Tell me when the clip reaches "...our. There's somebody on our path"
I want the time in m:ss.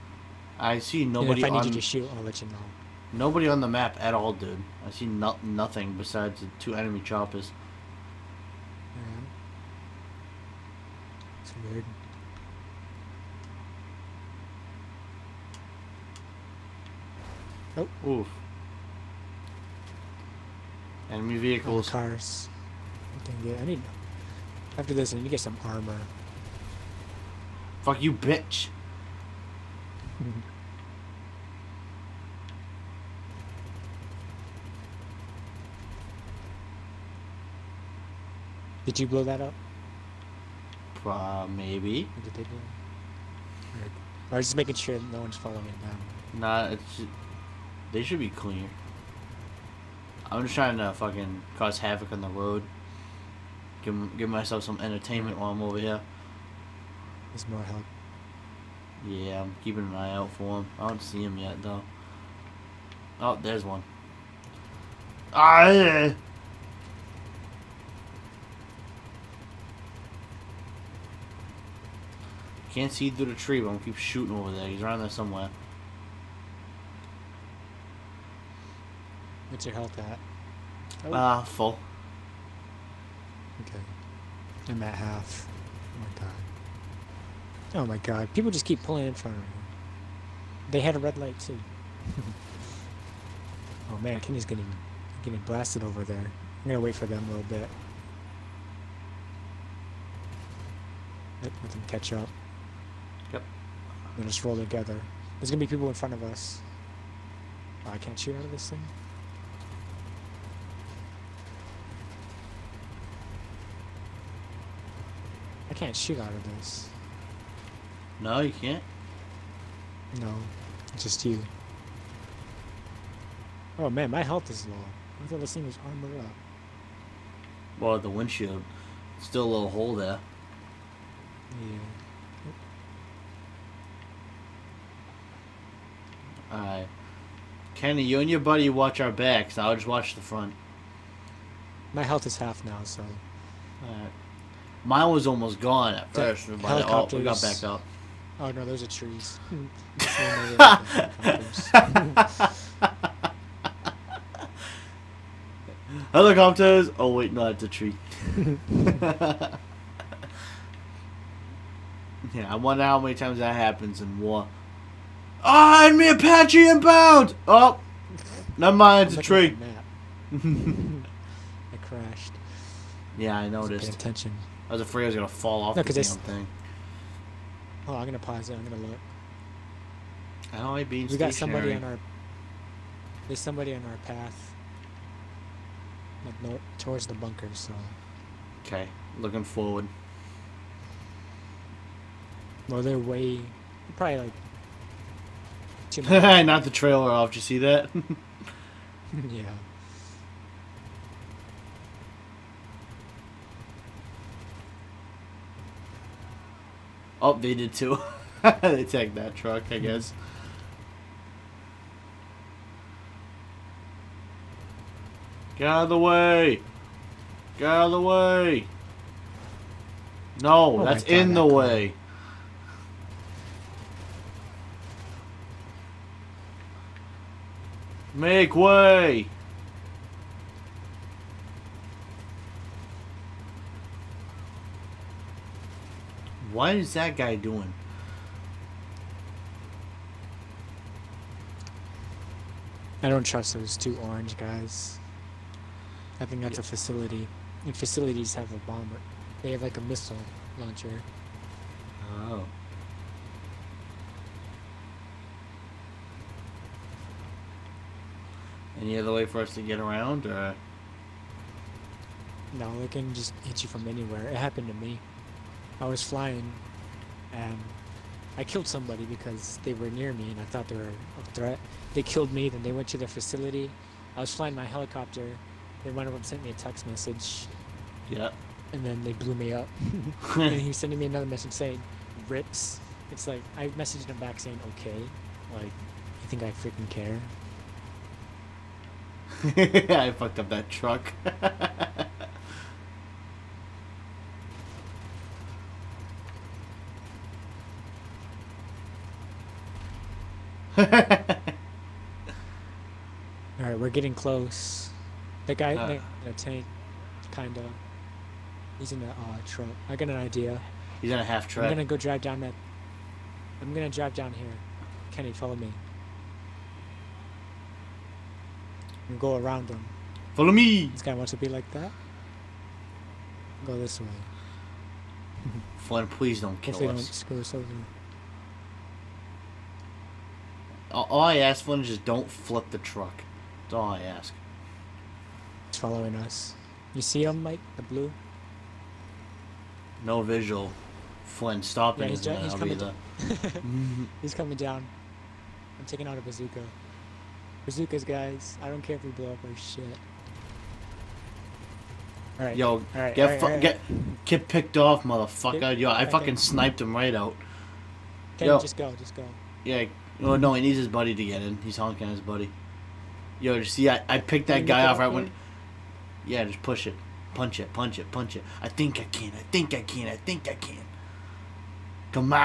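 3:01.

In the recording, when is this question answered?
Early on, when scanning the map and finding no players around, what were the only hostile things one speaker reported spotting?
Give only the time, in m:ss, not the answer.
0:06.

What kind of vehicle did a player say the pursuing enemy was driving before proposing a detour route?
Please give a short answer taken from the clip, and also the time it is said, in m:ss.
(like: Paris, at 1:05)
half truck, at 5:11.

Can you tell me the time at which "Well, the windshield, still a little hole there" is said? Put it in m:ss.
2:07.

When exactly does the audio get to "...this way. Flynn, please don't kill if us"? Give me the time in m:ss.
5:23.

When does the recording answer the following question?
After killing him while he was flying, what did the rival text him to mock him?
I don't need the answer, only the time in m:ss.
4:42.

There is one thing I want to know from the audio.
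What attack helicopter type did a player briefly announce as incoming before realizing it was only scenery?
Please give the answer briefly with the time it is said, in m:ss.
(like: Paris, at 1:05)
Apache, at 2:46.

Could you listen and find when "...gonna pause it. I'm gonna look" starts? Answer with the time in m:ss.
2:58.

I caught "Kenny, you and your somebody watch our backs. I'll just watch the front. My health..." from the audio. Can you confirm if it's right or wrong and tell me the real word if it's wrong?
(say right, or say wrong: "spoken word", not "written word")
wrong: "buddy", not "somebody".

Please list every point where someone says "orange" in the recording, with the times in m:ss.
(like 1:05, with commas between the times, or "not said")
4:04.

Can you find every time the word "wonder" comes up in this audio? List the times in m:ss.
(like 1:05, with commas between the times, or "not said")
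2:42.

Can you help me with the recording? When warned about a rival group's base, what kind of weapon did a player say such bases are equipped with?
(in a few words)
missile launcher.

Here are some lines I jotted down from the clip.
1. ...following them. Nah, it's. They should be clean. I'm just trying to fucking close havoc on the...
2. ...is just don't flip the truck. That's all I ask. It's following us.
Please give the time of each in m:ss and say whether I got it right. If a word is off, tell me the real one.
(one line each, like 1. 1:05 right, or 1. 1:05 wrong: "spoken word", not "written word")
1. 0:45 wrong: "cause", not "close"
2. 5:31 right.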